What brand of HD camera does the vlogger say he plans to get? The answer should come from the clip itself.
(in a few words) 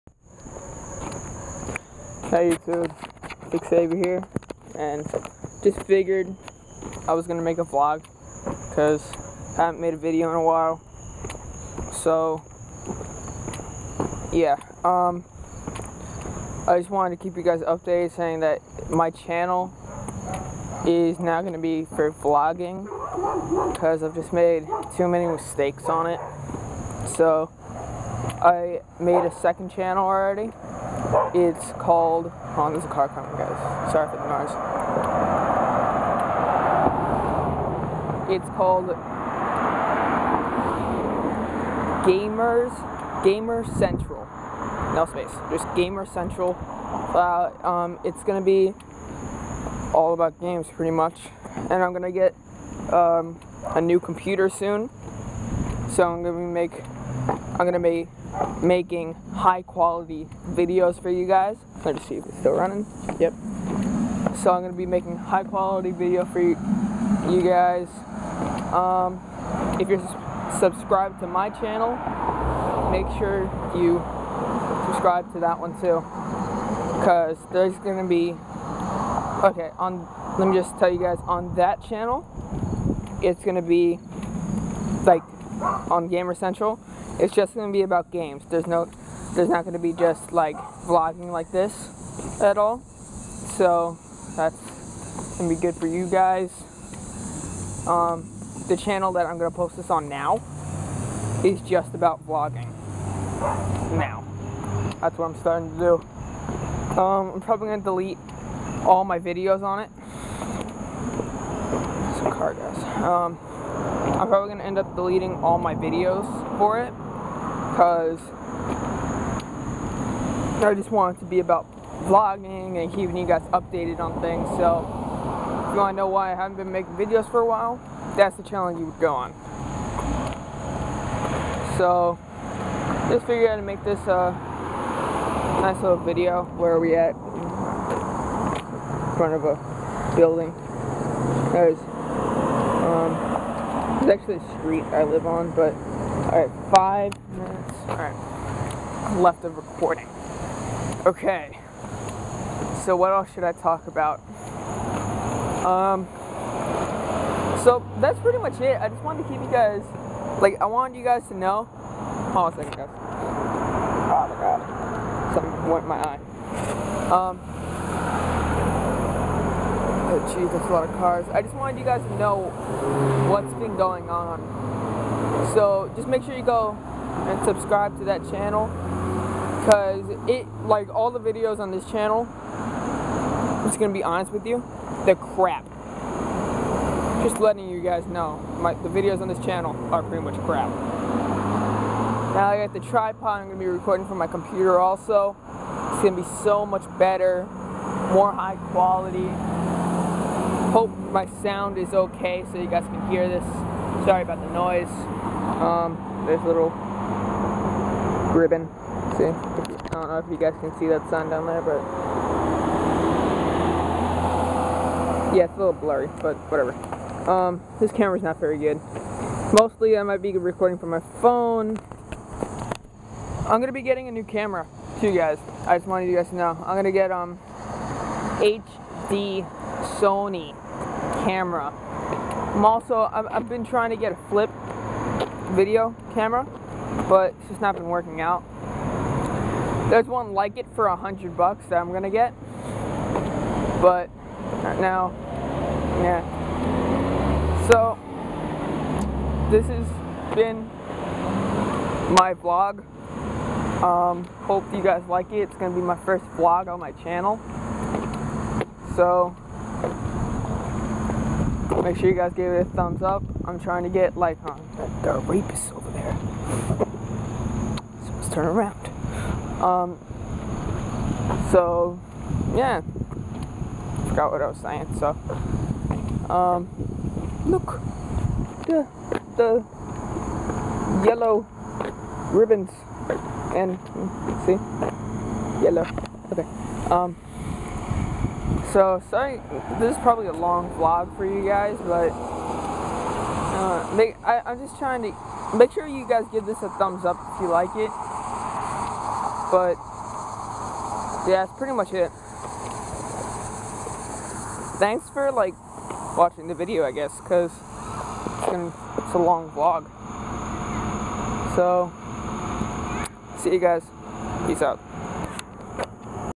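Sony.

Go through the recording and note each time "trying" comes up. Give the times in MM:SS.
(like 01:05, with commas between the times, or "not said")
03:53, 04:23, 04:54.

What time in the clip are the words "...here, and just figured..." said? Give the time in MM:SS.
00:04.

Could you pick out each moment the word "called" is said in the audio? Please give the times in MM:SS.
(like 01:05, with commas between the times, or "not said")
00:31, 00:38.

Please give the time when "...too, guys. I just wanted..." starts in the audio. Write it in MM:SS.
03:44.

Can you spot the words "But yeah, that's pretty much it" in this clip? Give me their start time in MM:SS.
04:59.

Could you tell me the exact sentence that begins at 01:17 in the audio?
Cause there's gonna be okay on.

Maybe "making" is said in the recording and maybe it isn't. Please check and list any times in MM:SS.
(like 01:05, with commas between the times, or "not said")
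00:58, 01:04, 02:06.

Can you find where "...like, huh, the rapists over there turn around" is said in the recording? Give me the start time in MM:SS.
04:24.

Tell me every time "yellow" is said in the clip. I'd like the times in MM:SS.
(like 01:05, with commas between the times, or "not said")
04:41, 04:45.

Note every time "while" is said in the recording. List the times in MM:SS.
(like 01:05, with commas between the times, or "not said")
00:10, 02:07.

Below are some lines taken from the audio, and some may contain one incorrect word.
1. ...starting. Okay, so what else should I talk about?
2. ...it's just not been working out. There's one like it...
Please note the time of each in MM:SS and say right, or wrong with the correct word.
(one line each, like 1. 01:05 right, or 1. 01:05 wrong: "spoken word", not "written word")
1. 02:29 wrong: "recording", not "starting"
2. 03:57 right.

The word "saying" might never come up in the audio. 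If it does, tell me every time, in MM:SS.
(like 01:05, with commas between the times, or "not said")
00:18, 04:34.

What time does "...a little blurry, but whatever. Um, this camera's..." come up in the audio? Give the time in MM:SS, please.
03:35.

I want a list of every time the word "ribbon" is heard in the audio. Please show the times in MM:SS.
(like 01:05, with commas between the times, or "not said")
03:28, 04:42.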